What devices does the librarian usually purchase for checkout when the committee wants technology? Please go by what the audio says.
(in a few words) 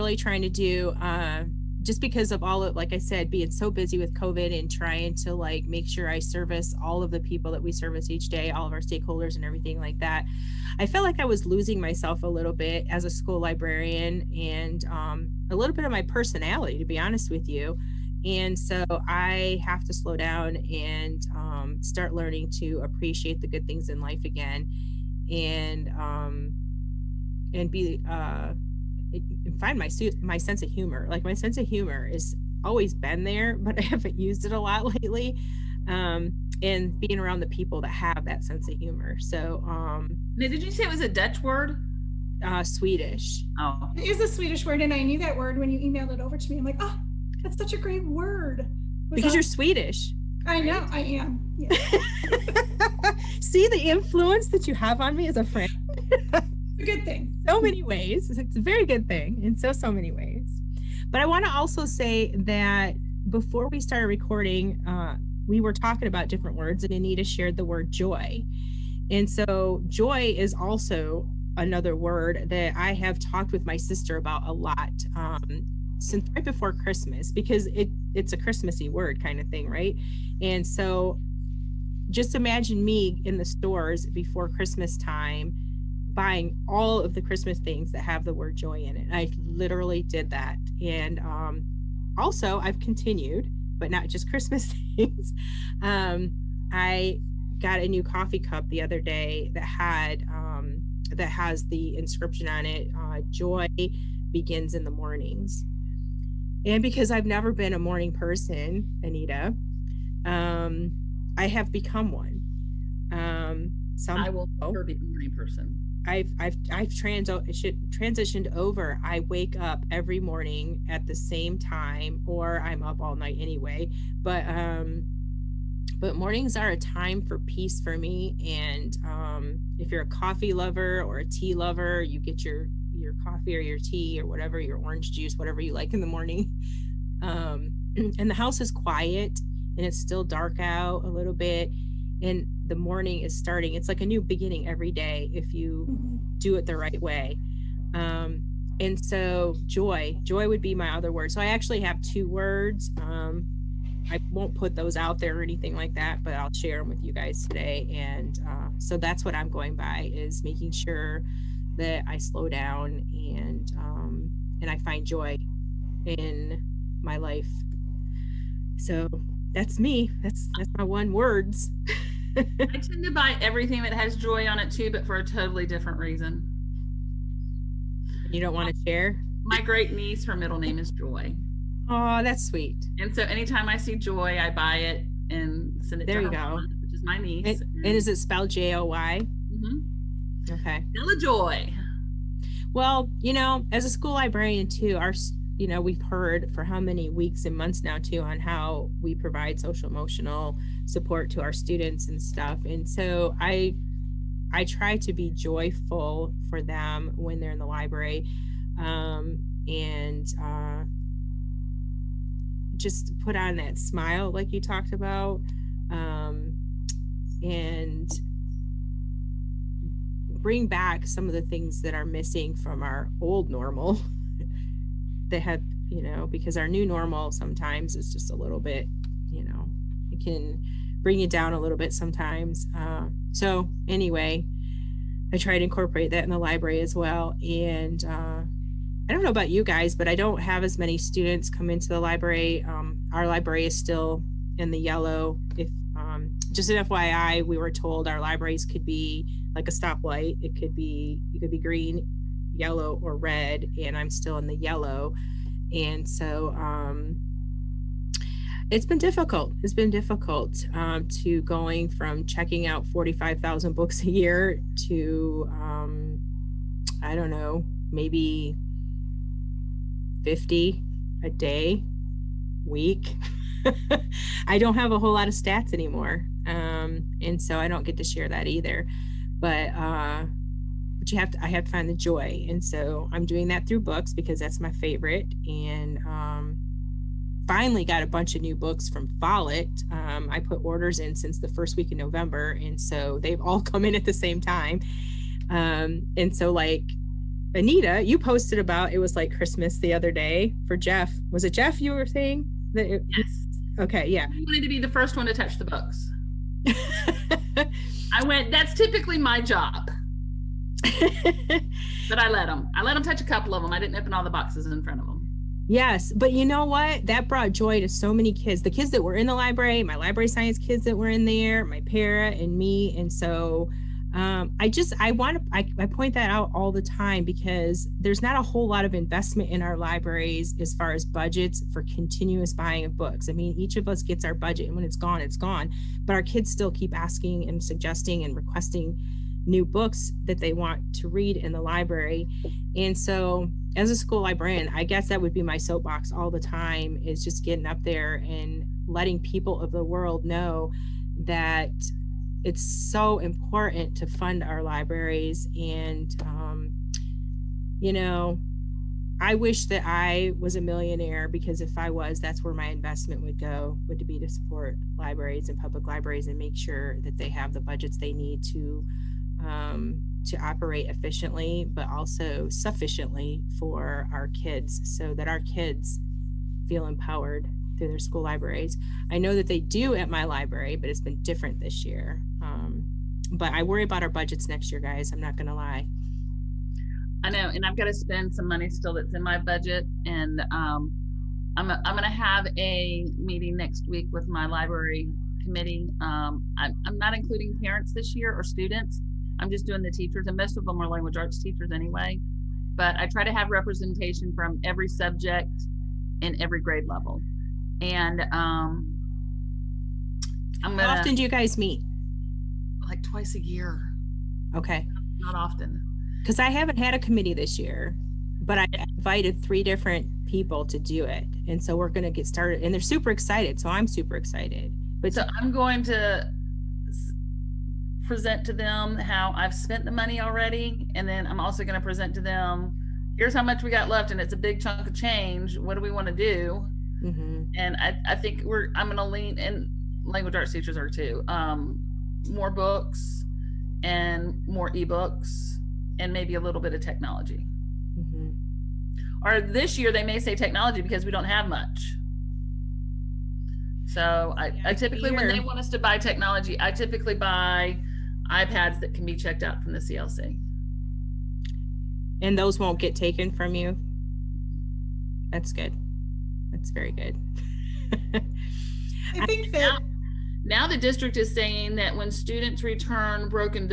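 iPads.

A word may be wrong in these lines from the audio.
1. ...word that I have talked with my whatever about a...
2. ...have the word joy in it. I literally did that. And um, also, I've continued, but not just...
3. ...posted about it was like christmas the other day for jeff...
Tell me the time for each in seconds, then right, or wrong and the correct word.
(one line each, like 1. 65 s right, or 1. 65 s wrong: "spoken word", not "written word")
1. 71 s wrong: "sister", not "whatever"
2. 88 s right
3. 298 s right.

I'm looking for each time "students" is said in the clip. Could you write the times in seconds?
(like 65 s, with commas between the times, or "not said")
201 s, 240 s, 398 s, 472 s.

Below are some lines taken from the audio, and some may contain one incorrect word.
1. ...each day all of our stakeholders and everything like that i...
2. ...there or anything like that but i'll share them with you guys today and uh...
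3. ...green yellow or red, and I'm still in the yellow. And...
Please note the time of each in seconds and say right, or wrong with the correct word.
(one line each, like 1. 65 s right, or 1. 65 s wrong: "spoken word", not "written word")
1. 8 s right
2. 155 s right
3. 251 s right.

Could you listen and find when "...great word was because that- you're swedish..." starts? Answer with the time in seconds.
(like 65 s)
47 s.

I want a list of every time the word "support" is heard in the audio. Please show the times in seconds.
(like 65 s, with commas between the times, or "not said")
200 s, 364 s.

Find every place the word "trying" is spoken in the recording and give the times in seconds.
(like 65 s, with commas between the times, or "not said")
0 s, 4 s.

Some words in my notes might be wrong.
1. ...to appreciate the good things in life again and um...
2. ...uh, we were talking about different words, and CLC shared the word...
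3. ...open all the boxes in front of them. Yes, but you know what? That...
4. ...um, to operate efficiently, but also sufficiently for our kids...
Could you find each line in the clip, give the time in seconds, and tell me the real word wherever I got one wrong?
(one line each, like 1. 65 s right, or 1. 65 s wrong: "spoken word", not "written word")
1. 22 s right
2. 64 s wrong: "Anita", not "CLC"
3. 313 s right
4. 369 s right.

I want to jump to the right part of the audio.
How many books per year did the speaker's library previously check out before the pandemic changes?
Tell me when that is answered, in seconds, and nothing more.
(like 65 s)
262 s.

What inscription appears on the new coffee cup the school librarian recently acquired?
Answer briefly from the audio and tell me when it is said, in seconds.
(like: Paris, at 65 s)
Joy begins in the mornings, at 103 s.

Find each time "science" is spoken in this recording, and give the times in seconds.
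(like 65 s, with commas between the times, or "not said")
320 s.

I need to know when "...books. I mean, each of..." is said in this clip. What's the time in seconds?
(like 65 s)
332 s.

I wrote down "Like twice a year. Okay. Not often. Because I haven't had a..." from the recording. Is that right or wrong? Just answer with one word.
right.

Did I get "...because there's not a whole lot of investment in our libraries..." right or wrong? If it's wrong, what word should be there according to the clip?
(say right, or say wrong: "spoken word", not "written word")
right.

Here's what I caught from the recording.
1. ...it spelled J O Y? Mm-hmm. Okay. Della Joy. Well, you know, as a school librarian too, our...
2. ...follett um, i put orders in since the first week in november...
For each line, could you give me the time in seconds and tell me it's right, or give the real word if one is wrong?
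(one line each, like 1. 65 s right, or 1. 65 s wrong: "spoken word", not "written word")
1. 188 s right
2. 289 s right.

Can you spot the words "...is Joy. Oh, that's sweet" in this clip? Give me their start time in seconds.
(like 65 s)
180 s.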